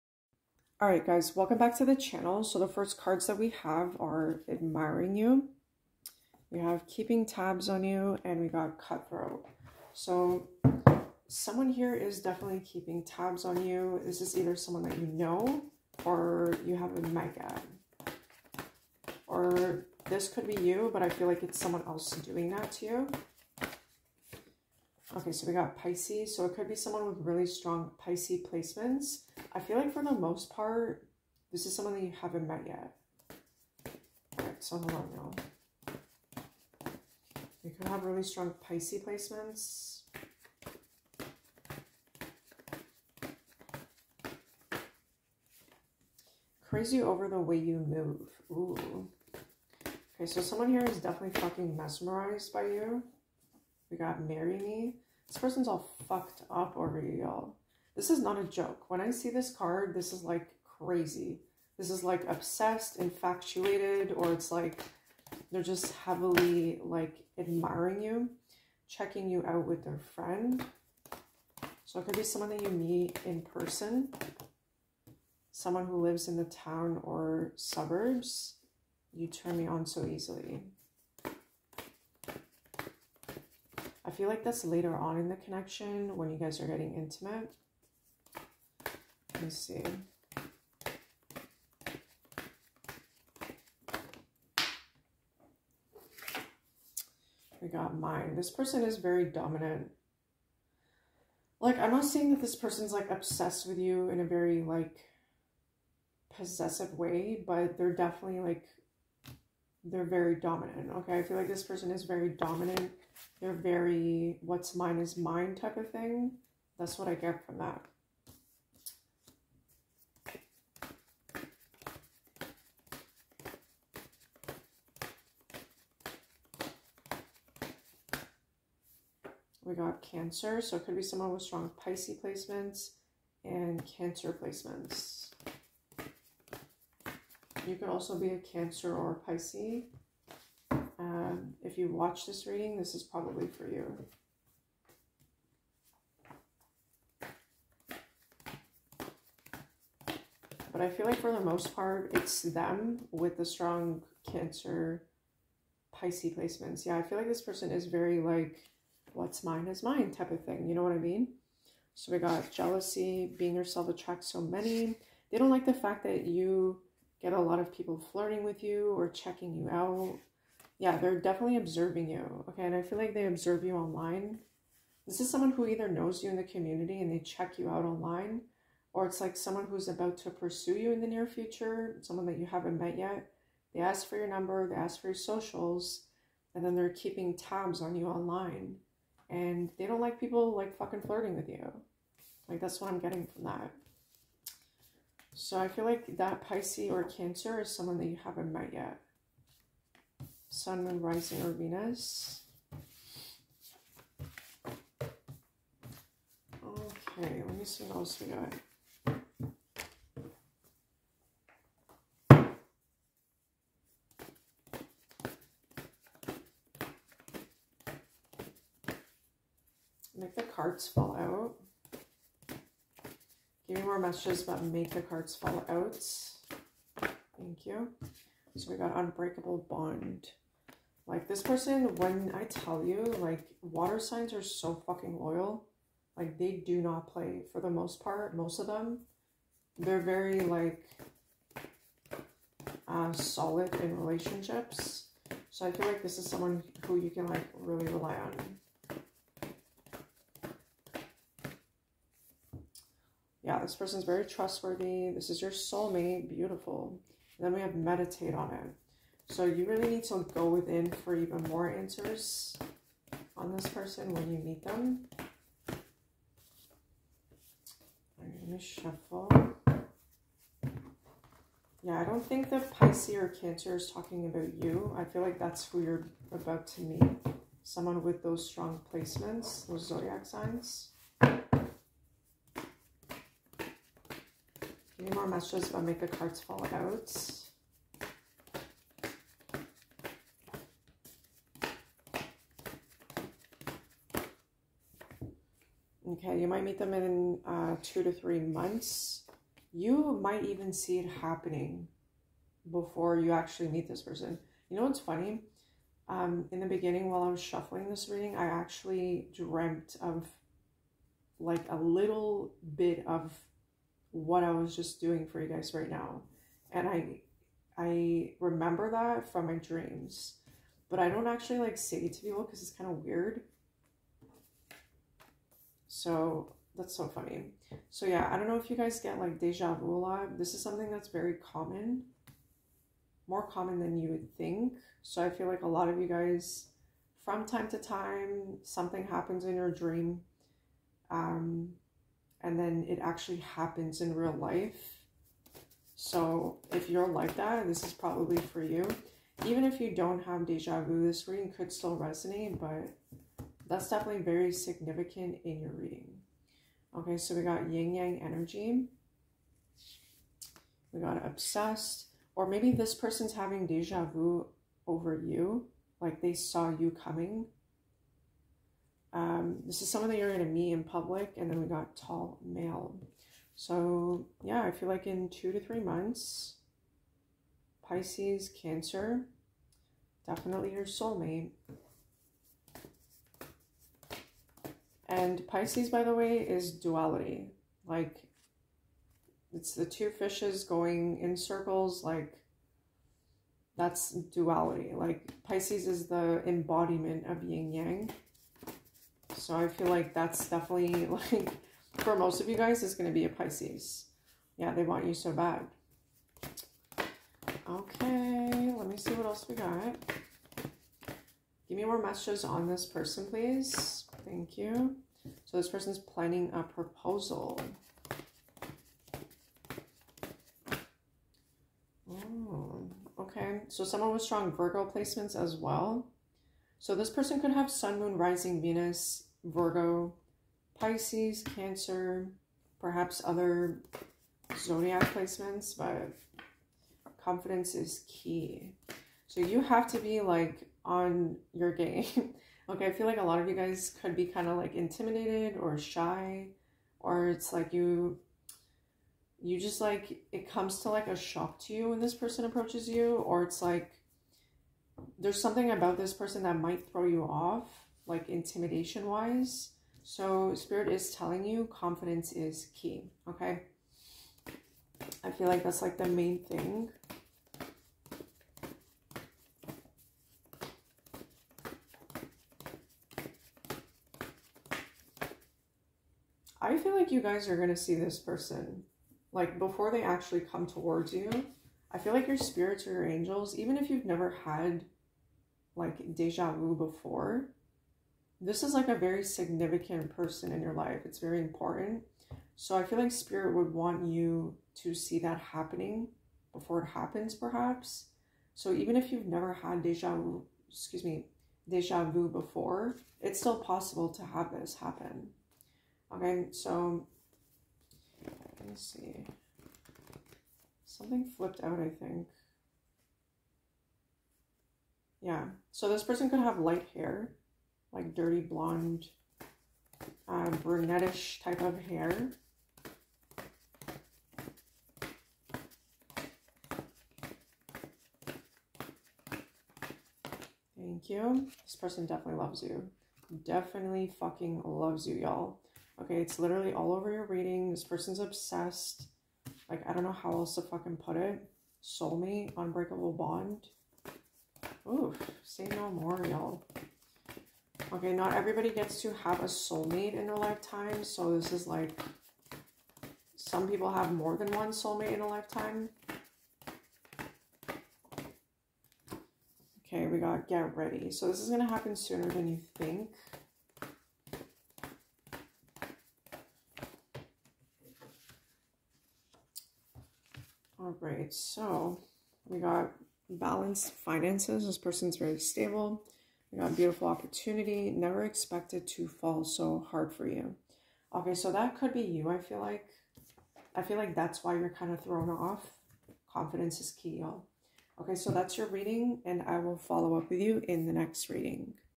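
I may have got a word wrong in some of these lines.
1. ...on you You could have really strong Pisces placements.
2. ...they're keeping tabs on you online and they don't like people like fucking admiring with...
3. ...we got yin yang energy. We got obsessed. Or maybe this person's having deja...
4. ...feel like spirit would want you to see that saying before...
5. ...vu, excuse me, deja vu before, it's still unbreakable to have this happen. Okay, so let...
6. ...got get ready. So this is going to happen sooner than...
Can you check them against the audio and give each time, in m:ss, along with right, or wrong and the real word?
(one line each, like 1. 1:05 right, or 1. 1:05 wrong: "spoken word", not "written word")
1. 0:34 right
2. 3:06 wrong: "flirting", not "admiring"
3. 5:57 right
4. 8:12 wrong: "happening", not "saying"
5. 8:20 wrong: "possible", not "unbreakable"
6. 9:20 right.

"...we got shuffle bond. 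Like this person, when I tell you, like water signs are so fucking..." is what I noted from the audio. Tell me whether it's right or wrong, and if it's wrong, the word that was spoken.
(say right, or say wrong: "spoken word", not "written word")
wrong: "unbreakable", not "shuffle".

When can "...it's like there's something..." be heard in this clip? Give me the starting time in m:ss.
7:33.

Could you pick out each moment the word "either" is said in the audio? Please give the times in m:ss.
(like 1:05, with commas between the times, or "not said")
0:14, 2:55.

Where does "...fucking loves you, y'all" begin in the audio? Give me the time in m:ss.
8:54.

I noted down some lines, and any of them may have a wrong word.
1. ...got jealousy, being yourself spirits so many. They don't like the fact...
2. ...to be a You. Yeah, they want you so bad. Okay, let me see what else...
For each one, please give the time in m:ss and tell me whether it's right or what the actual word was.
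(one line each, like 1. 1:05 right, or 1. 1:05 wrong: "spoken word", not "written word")
1. 2:42 wrong: "attracts", not "spirits"
2. 6:43 wrong: "Pisces", not "You".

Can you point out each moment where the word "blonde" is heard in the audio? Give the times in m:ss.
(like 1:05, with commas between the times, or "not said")
8:38.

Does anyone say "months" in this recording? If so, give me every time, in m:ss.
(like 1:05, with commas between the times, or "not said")
4:58, 6:15.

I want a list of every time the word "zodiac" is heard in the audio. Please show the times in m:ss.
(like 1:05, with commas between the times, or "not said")
4:39, 7:14.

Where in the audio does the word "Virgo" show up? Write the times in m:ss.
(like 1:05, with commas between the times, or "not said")
7:04, 7:09.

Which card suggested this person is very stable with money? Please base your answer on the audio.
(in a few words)
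Balanced finances.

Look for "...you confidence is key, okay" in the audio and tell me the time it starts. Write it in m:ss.
7:41.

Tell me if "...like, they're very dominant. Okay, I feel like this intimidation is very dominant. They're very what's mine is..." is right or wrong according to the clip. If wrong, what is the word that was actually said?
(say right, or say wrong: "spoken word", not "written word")
wrong: "person", not "intimidation".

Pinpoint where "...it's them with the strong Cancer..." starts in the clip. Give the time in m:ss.
2:32.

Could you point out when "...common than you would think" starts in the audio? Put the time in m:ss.
5:33.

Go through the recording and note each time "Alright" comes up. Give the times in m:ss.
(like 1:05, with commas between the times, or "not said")
0:00, 0:34.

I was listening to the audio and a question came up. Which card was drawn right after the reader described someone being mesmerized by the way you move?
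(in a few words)
Marry Me.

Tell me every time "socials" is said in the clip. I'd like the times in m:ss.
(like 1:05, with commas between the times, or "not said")
3:05.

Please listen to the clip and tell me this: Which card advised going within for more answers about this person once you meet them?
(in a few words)
Meditate on it.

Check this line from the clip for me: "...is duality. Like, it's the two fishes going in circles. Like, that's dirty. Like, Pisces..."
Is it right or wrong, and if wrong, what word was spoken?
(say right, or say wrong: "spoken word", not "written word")
wrong: "duality", not "dirty".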